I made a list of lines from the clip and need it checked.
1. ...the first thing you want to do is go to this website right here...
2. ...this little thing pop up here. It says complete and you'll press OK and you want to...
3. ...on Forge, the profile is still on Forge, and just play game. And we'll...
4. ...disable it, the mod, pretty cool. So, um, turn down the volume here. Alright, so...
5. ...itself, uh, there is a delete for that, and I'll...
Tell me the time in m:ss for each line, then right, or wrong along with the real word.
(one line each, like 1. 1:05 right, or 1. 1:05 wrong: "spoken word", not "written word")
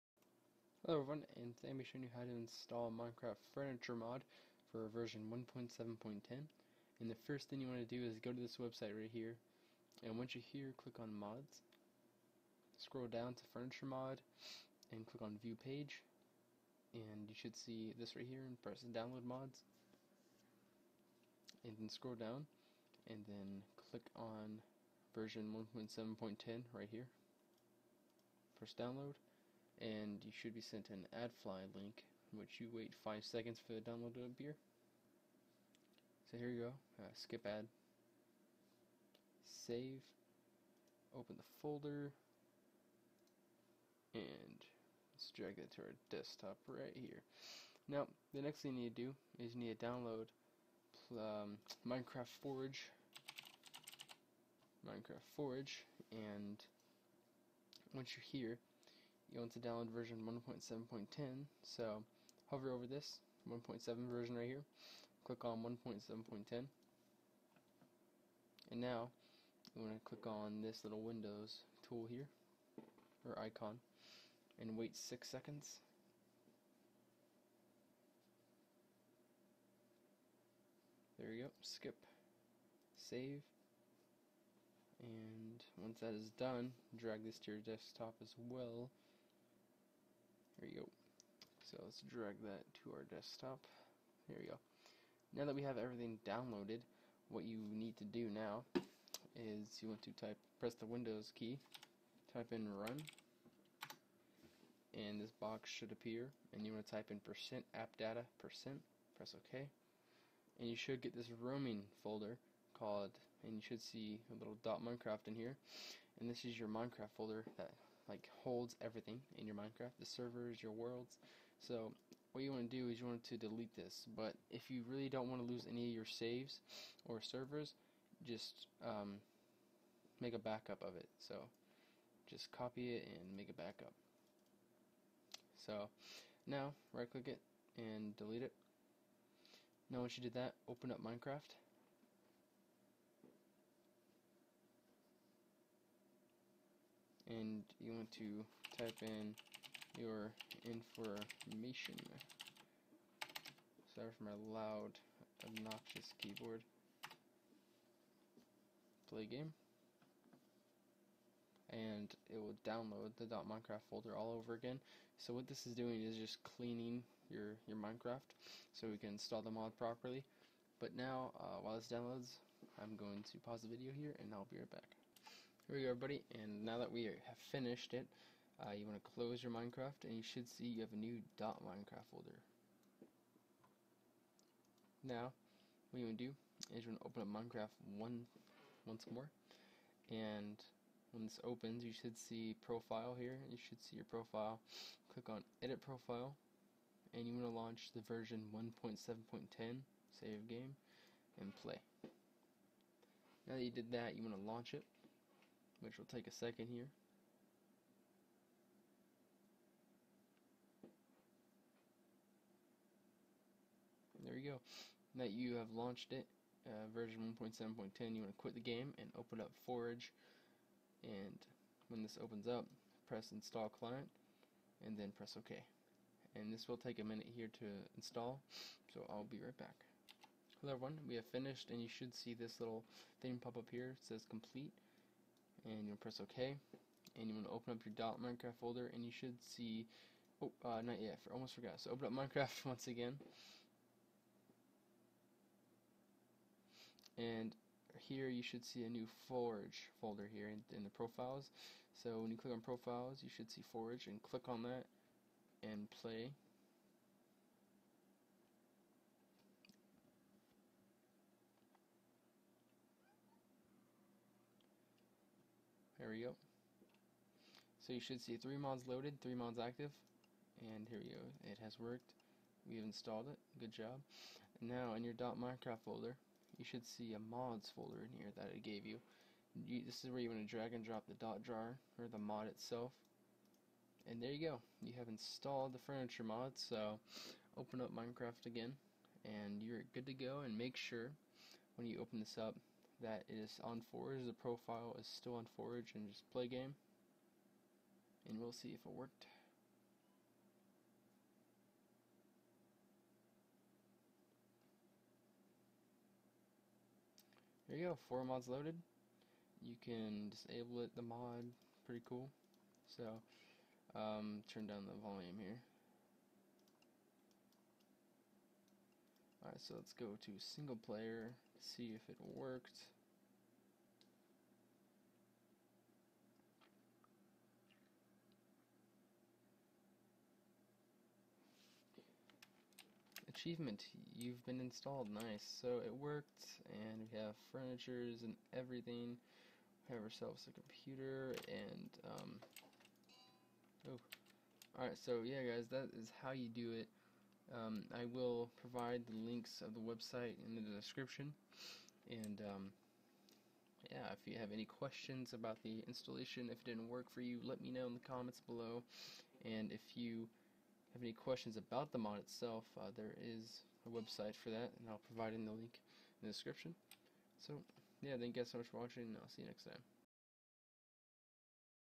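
1. 0:07 right
2. 3:52 right
3. 4:53 right
4. 5:10 right
5. 6:02 wrong: "website", not "delete".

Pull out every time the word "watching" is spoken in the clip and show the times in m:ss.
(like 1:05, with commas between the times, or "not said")
6:08.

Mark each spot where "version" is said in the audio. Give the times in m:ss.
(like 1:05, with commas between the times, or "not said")
0:04, 0:25, 0:59, 1:04, 3:18, 3:36.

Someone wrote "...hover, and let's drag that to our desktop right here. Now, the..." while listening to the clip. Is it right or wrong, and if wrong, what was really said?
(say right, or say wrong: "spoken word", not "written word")
wrong: "folder", not "hover".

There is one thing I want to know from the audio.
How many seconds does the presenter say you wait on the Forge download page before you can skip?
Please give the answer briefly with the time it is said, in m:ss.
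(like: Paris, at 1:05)
6, at 1:14.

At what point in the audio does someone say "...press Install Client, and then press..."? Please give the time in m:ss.
3:43.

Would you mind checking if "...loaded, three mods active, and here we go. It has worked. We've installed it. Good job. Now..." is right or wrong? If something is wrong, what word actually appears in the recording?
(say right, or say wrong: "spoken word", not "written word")
right.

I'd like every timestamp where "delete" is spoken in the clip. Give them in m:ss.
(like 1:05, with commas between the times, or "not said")
2:03, 2:18.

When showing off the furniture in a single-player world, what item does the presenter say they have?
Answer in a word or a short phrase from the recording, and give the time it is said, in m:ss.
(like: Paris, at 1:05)
A computer, at 5:40.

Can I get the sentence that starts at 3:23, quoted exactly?
Now that you did that, you want to launch it which will take a second here.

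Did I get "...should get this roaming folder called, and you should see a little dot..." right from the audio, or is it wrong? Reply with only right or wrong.
right.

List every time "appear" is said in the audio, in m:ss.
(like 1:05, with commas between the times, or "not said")
0:34, 1:45.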